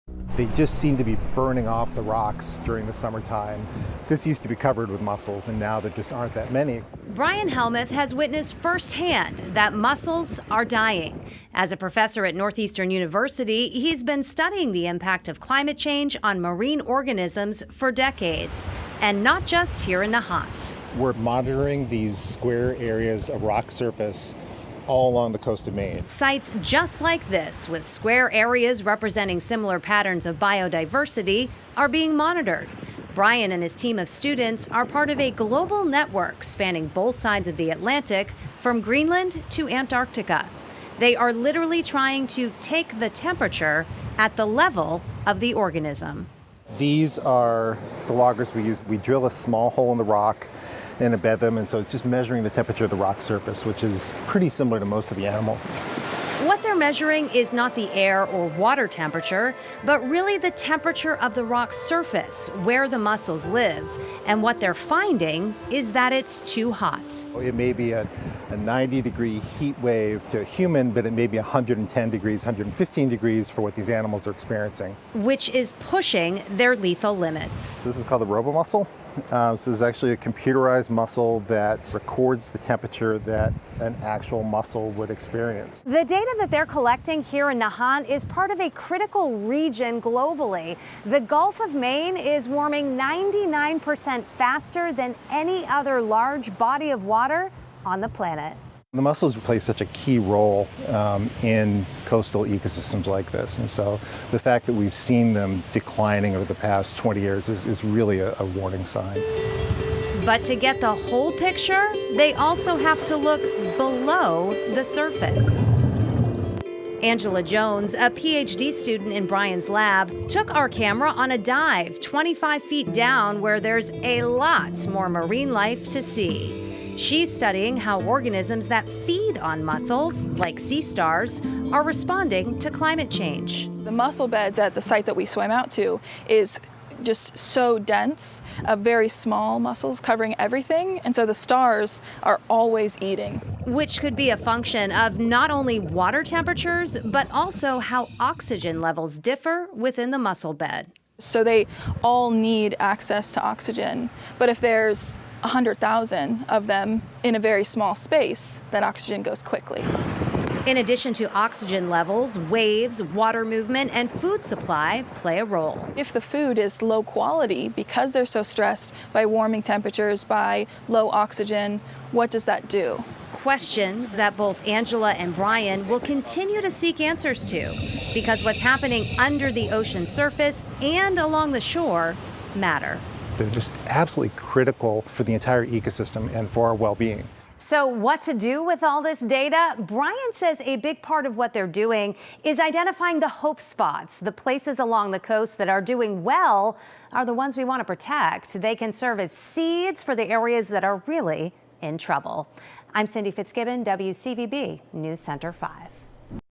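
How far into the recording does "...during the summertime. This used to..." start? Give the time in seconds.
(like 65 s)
2 s.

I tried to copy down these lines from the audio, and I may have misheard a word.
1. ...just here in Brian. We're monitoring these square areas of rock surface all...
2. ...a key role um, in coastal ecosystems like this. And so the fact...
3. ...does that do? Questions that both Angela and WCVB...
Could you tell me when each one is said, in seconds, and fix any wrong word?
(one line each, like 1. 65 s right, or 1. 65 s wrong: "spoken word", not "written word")
1. 19 s wrong: "Nahant", not "Brian"
2. 99 s right
3. 172 s wrong: "Brian", not "WCVB".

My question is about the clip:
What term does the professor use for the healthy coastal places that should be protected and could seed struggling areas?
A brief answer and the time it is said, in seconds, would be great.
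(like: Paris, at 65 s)
hope spots, at 193 s.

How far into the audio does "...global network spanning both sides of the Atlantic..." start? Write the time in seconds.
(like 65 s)
35 s.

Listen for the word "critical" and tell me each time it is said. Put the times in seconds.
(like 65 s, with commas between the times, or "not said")
88 s, 184 s.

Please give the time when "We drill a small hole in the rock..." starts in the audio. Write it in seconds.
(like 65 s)
48 s.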